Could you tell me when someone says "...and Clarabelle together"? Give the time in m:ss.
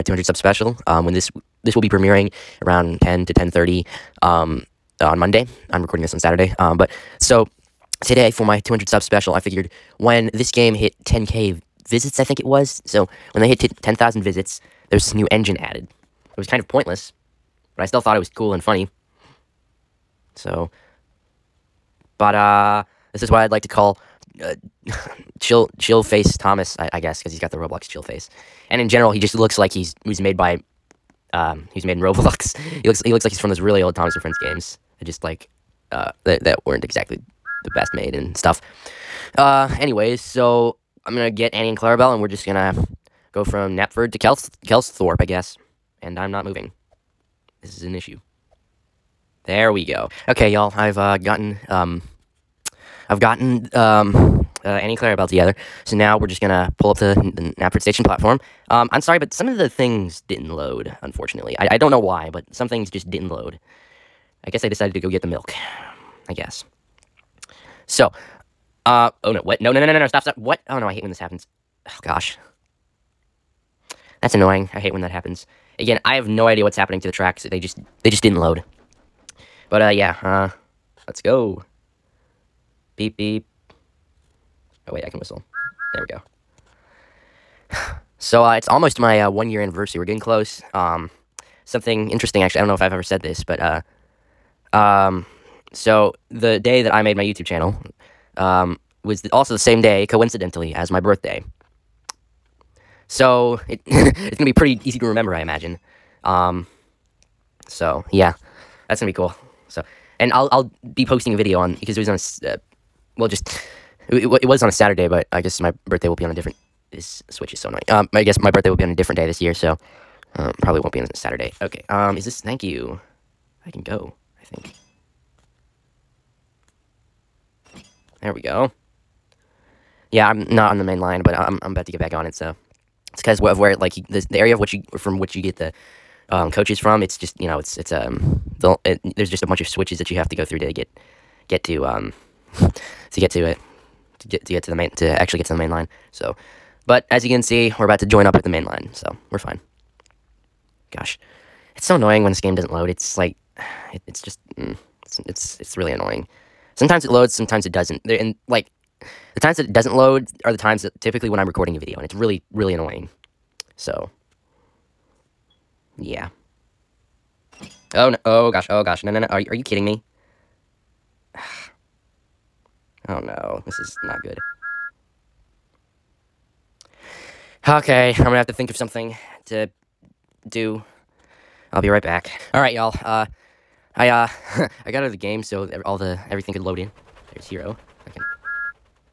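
0:54.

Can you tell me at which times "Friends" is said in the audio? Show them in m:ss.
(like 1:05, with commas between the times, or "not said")
0:34.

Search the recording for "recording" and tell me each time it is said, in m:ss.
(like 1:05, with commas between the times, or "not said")
0:05, 2:41.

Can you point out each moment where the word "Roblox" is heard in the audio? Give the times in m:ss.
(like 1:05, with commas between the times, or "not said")
0:27, 0:32.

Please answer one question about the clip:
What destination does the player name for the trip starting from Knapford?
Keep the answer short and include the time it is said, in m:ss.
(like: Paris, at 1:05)
Kelsthorpe, at 0:44.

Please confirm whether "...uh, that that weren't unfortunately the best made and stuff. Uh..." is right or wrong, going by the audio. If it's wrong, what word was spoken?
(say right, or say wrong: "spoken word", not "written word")
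wrong: "exactly", not "unfortunately".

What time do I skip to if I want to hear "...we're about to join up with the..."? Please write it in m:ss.
2:27.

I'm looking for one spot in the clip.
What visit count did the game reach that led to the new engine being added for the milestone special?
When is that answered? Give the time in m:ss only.
0:13.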